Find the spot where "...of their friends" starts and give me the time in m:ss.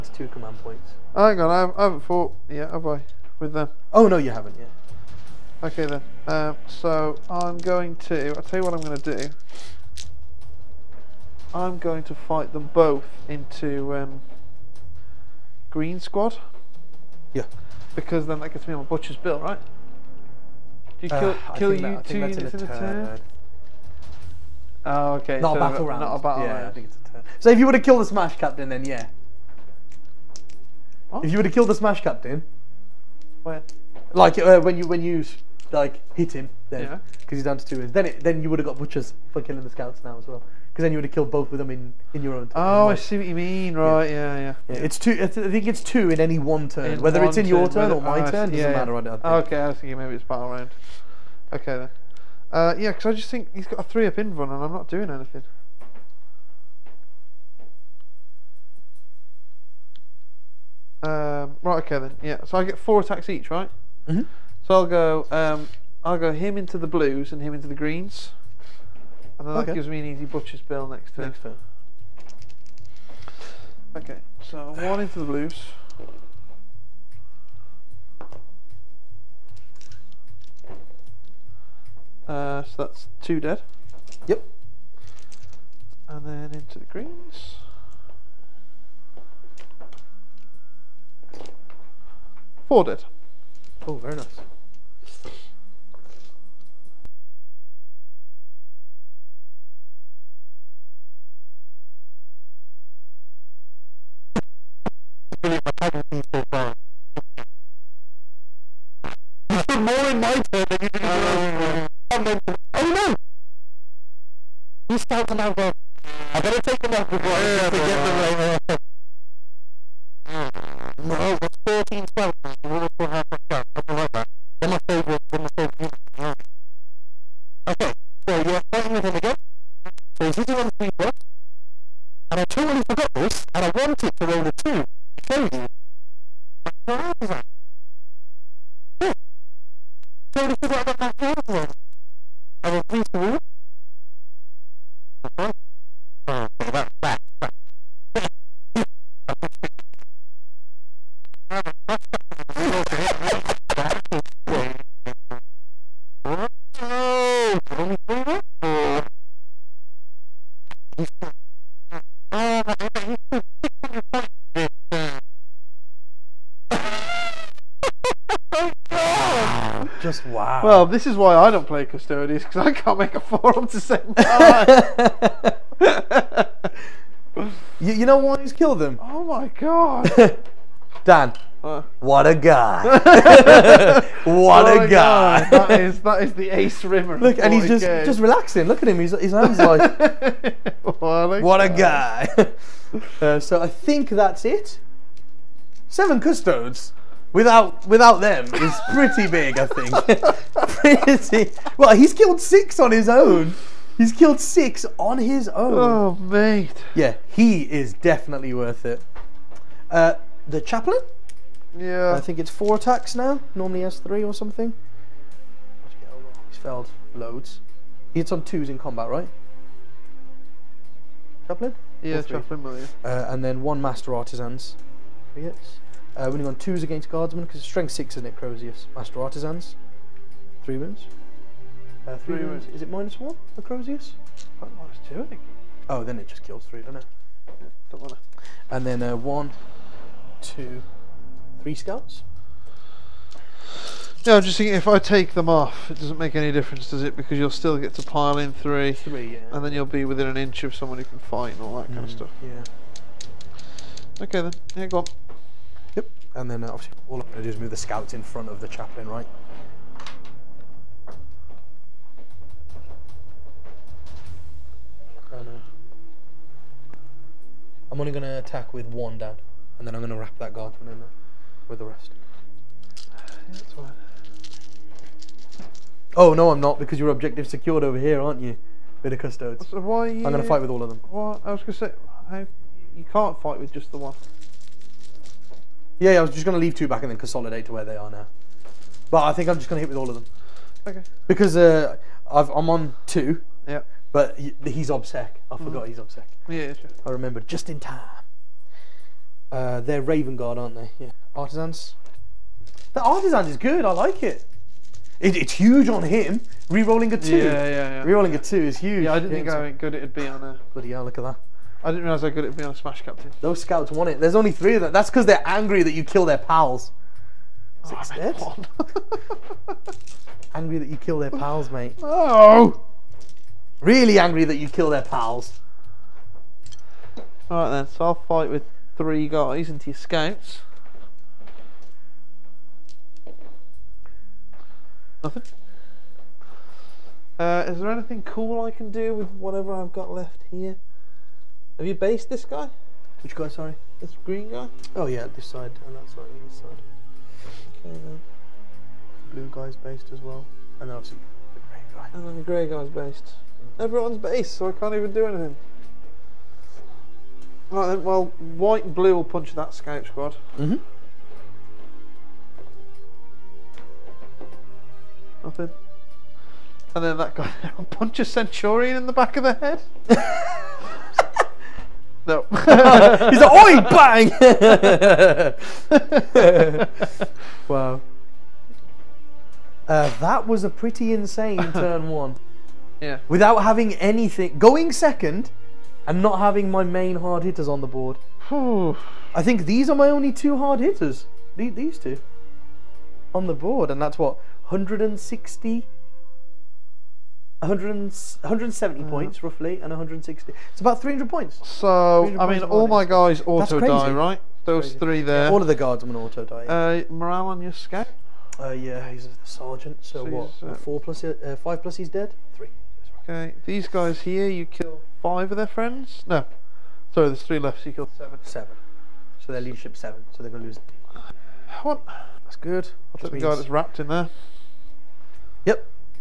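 6:55.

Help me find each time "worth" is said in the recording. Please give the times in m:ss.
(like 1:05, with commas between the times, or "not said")
3:28.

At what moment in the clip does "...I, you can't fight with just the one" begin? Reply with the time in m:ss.
4:42.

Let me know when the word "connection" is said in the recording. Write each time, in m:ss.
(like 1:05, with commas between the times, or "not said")
not said.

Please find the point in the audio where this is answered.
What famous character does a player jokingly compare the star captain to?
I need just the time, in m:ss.
3:06.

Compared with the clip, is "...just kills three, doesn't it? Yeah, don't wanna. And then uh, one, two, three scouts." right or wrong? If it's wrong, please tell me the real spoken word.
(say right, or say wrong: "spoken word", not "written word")
right.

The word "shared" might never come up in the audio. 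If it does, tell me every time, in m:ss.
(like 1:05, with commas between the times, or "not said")
not said.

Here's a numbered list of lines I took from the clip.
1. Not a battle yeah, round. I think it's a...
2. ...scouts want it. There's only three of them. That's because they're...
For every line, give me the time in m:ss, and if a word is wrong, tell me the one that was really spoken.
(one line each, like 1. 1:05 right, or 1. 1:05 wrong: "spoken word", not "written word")
1. 0:26 right
2. 5:13 right.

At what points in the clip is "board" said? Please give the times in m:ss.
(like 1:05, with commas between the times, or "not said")
6:27, 6:33.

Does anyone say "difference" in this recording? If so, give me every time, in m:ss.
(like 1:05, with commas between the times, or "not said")
4:06.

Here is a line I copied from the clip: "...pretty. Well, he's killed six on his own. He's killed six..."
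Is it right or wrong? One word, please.
right.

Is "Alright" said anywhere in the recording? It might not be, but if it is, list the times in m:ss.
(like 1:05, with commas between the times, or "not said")
5:27.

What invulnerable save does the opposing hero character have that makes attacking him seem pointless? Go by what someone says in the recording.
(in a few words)
3+.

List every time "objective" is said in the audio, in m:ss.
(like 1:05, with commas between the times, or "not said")
4:37.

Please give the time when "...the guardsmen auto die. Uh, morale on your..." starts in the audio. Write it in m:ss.
6:45.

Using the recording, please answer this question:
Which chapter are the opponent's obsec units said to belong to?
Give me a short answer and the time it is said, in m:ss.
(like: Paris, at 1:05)
Raven Guard, at 5:00.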